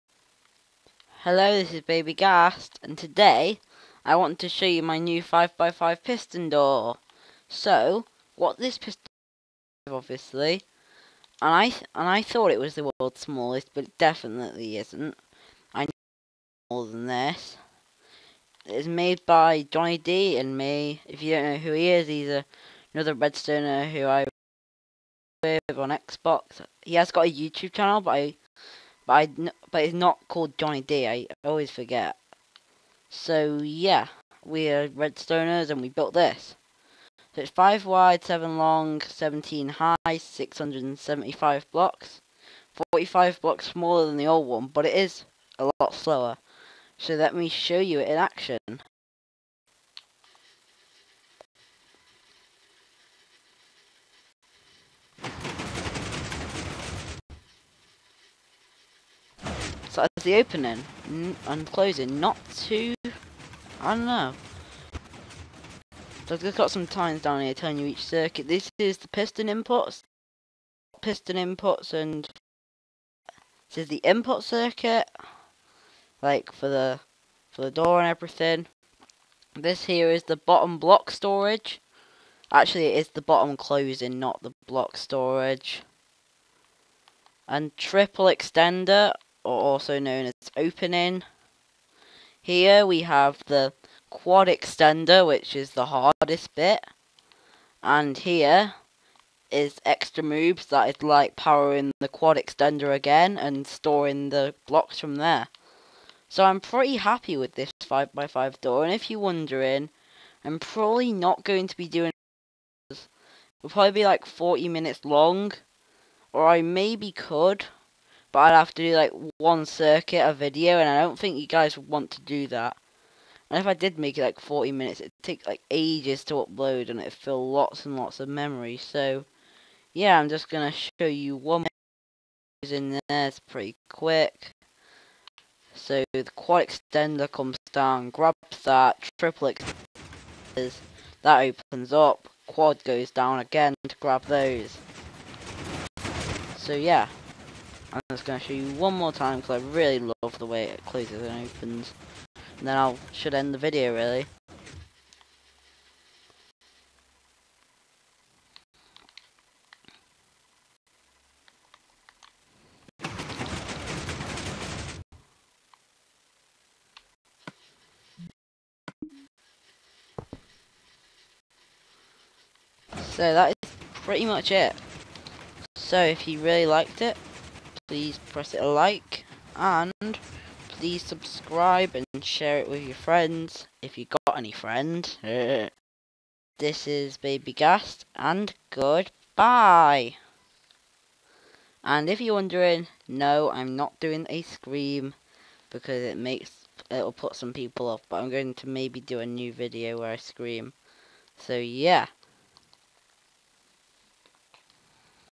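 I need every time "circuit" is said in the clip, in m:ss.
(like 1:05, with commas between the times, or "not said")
1:08, 1:14, 1:59.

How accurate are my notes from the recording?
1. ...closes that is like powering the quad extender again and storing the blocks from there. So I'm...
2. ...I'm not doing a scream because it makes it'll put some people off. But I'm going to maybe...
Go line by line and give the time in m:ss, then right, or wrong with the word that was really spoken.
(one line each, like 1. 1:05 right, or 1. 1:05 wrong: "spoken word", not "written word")
1. 1:40 wrong: "moves", not "closes"
2. 3:13 right.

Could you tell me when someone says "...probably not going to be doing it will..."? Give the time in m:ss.
1:50.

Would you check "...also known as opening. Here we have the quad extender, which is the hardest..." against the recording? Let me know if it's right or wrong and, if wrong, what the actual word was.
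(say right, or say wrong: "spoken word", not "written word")
right.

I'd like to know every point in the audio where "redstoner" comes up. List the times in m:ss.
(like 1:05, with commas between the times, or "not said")
0:23, 0:34.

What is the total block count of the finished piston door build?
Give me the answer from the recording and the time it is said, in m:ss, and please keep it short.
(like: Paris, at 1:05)
675 blocks, at 0:40.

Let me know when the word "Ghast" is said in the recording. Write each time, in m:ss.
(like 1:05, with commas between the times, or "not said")
0:02, 3:07.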